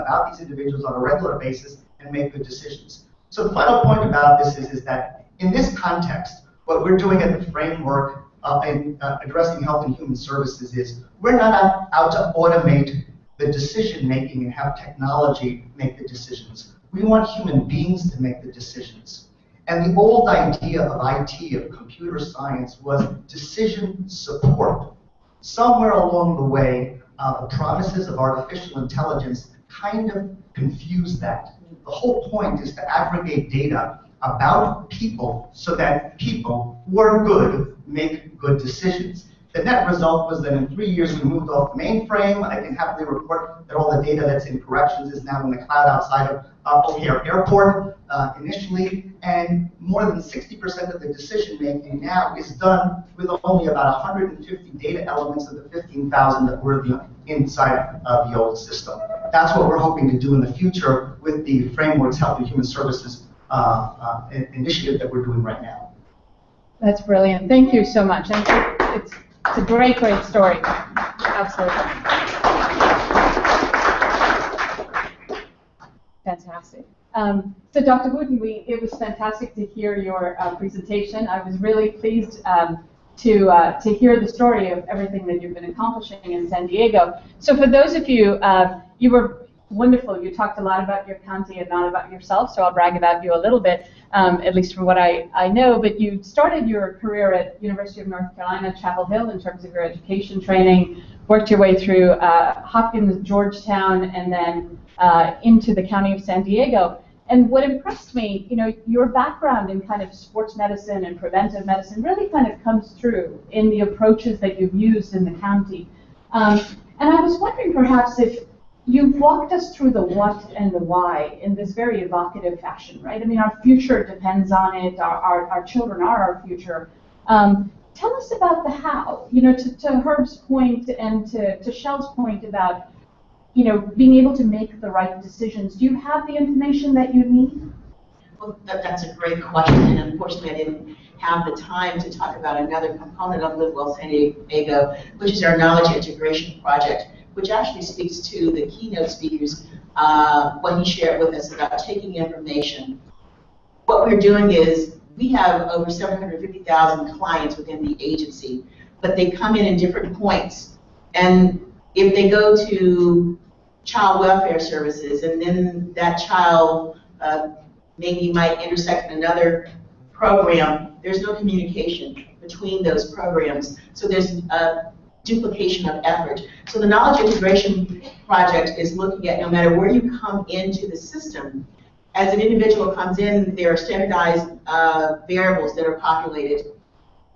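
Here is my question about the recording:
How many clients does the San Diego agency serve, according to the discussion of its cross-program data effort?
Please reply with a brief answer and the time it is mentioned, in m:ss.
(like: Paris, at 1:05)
750,000, at 2:35.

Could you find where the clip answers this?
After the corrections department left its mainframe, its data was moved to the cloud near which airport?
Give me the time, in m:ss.
0:46.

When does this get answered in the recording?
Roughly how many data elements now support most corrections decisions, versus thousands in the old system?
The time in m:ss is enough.
0:54.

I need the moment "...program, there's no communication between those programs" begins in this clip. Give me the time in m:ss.
2:50.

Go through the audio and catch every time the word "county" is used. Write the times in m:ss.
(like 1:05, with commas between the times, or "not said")
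1:31, 1:45, 1:55.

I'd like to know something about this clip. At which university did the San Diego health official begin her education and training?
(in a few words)
University of North Carolina, Chapel Hill.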